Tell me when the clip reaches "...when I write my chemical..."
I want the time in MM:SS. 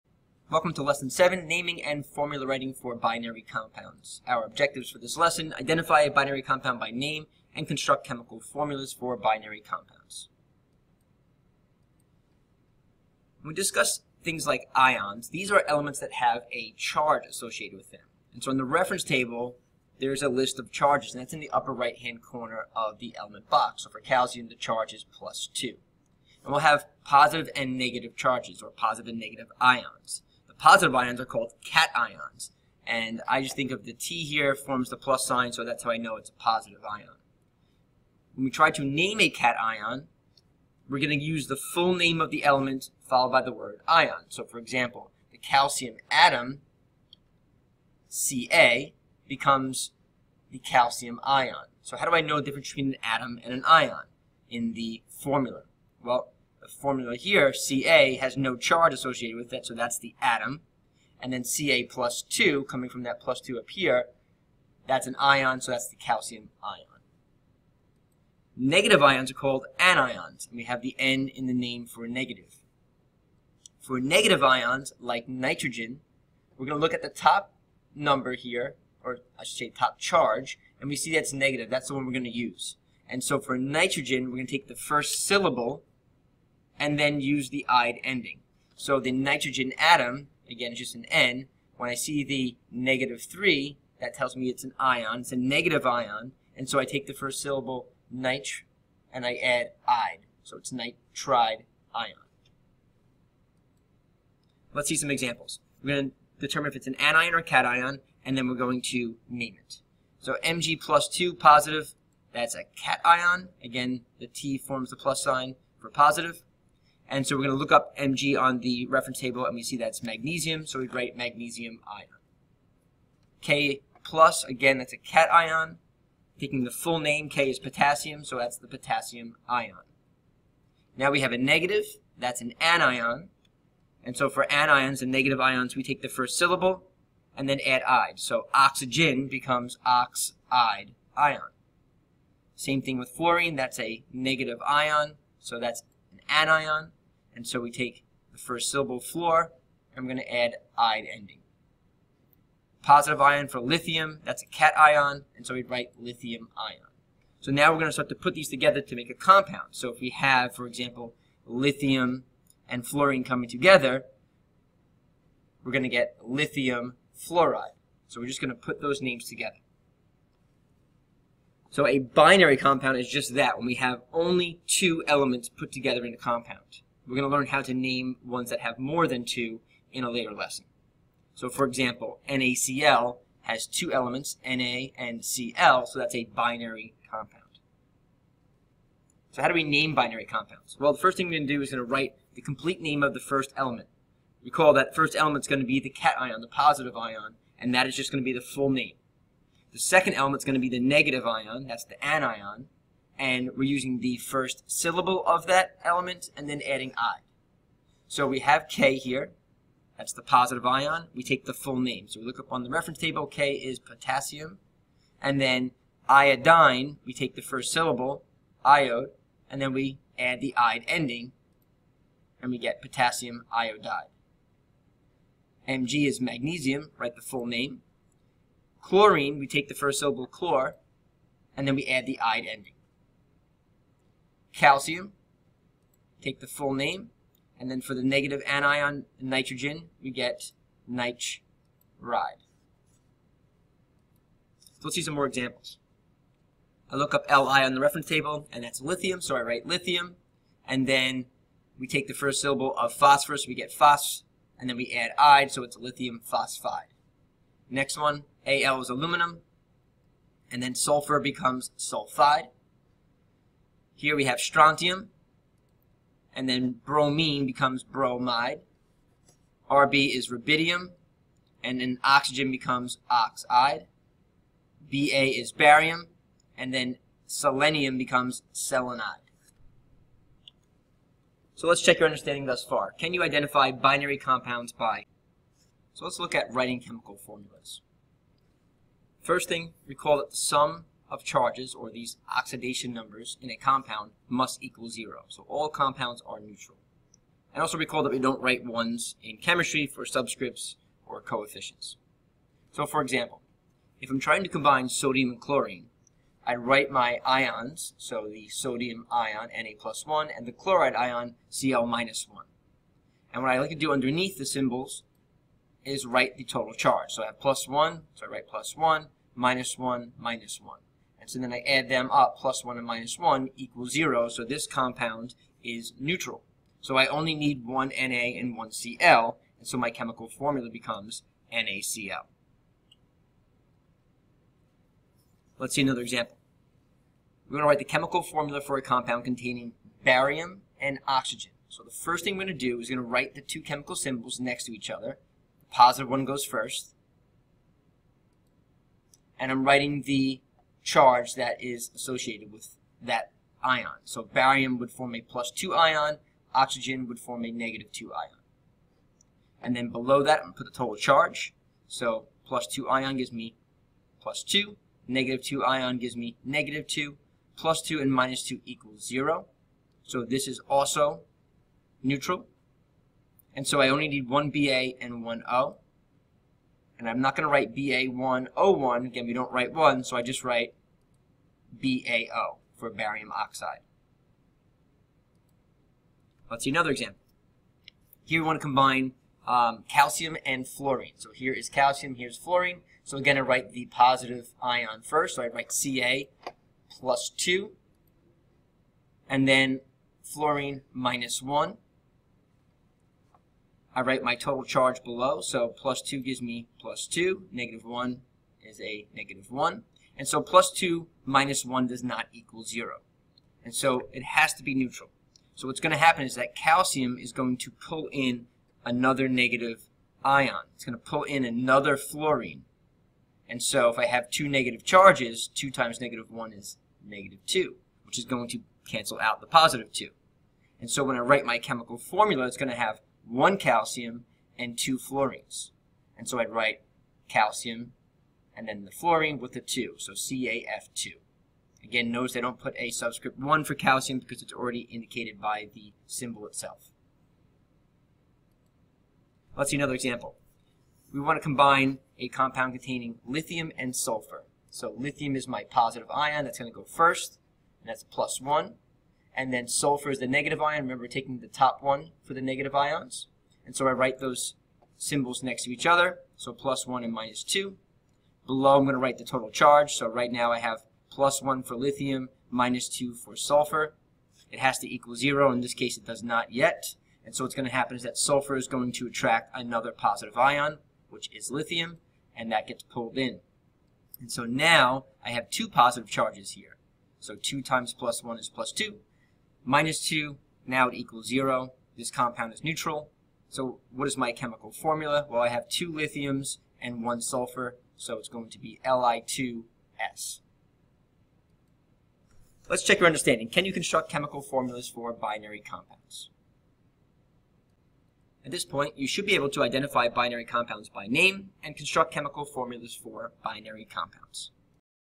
07:11.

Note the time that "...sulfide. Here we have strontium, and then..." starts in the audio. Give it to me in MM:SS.
04:21.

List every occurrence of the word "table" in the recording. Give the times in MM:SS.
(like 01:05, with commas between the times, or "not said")
00:19, 01:59, 03:32, 04:08.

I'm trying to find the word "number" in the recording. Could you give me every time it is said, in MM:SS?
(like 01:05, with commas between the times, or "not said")
01:17, 04:52.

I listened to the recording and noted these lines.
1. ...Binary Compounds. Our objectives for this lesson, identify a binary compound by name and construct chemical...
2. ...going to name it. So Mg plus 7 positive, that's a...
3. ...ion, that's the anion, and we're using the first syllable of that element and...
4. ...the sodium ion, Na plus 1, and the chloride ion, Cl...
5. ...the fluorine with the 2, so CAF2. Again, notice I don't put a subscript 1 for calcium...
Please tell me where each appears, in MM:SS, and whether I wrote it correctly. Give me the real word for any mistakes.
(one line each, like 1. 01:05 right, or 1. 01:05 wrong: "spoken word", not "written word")
1. 00:02 right
2. 01:48 wrong: "2", not "7"
3. 03:21 right
4. 05:08 right
5. 07:18 right.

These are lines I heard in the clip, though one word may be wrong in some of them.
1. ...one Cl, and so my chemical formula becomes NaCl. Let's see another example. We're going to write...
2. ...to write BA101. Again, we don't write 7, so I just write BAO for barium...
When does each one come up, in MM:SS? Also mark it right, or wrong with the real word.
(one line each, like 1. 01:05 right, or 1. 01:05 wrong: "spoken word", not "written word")
1. 05:28 right
2. 06:17 wrong: "1", not "7".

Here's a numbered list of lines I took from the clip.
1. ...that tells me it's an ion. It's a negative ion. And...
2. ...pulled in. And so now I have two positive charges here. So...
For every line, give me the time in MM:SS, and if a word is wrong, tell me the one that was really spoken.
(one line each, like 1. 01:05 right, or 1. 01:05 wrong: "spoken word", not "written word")
1. 01:34 right
2. 08:02 right.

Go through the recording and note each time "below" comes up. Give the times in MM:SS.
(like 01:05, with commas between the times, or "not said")
05:59, 06:45, 07:48.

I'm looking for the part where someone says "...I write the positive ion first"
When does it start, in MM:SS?
06:33.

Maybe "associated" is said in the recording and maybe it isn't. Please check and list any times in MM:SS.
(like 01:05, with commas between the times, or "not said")
00:17, 00:58, 05:51.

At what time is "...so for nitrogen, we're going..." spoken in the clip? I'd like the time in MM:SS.
01:23.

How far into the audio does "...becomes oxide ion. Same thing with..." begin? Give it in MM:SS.
02:19.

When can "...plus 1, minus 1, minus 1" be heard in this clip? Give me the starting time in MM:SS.
05:18.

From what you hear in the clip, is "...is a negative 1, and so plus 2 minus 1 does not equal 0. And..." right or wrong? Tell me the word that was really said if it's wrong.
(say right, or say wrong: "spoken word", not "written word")
right.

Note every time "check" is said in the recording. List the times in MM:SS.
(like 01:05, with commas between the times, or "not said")
04:41, 08:22.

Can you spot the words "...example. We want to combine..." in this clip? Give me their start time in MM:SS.
07:29.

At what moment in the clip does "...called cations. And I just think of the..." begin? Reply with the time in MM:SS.
00:31.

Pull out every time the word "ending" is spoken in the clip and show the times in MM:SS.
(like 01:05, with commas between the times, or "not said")
01:28, 02:31, 03:40, 03:52.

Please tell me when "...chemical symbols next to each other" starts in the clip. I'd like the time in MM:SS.
05:43.